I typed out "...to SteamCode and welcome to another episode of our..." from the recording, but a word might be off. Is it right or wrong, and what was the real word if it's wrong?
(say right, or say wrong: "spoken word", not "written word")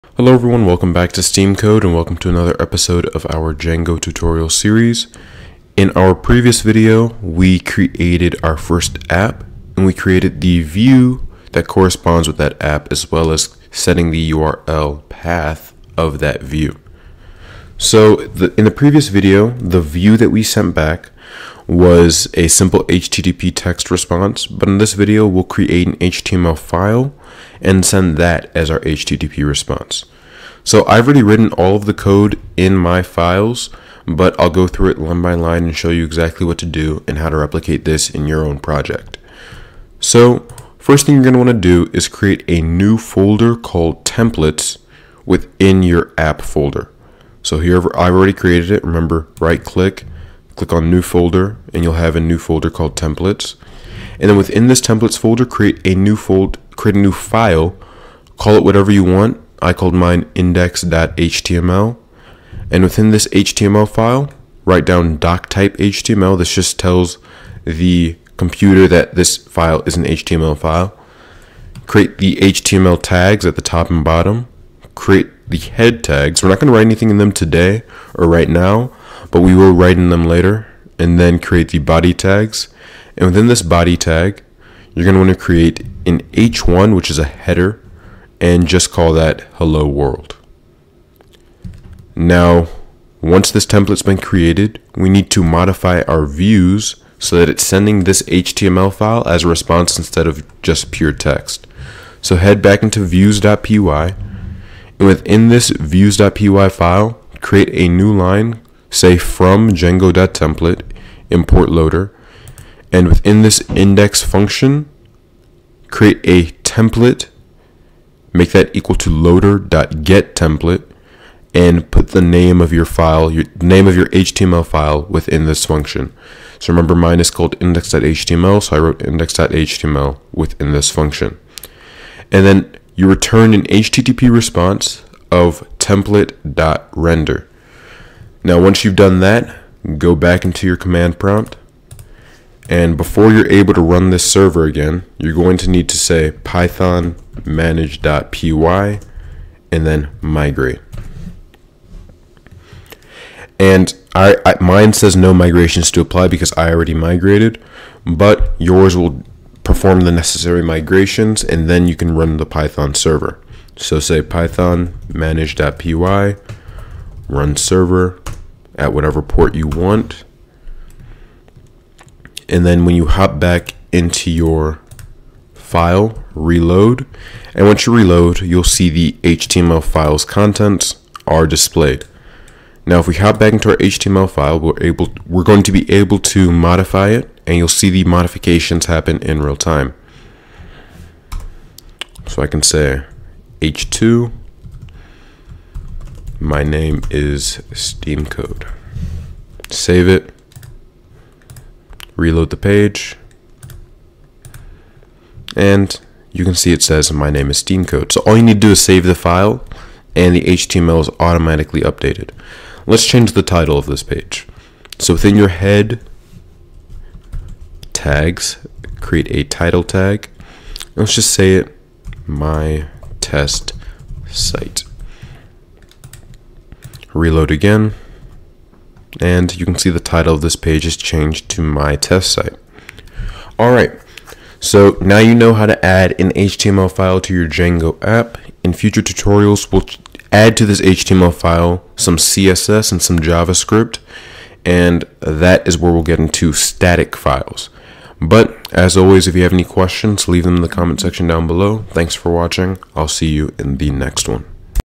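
right.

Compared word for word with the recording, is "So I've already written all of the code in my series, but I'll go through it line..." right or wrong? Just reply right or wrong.
wrong.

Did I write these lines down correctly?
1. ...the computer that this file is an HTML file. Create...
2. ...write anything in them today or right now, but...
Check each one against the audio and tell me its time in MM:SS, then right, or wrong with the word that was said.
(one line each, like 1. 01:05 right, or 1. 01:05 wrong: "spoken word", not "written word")
1. 01:07 right
2. 01:16 right.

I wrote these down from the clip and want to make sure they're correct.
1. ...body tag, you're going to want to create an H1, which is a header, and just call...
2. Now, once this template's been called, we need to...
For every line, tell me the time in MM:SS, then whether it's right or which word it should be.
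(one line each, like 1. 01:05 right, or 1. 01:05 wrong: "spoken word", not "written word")
1. 01:23 right
2. 01:32 wrong: "created", not "called".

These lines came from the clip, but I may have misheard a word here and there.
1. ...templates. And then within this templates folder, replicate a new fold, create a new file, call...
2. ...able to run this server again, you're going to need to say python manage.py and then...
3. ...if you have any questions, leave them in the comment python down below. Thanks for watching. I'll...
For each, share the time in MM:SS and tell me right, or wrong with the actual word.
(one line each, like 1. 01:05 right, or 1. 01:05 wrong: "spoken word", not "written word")
1. 00:52 wrong: "create", not "replicate"
2. 02:23 right
3. 04:09 wrong: "section", not "python".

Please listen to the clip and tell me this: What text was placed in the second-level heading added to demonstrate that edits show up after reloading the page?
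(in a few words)
my name is steam code.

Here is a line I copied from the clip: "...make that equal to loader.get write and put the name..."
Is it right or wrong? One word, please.
wrong.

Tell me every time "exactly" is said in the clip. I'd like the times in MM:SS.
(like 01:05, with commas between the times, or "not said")
00:36.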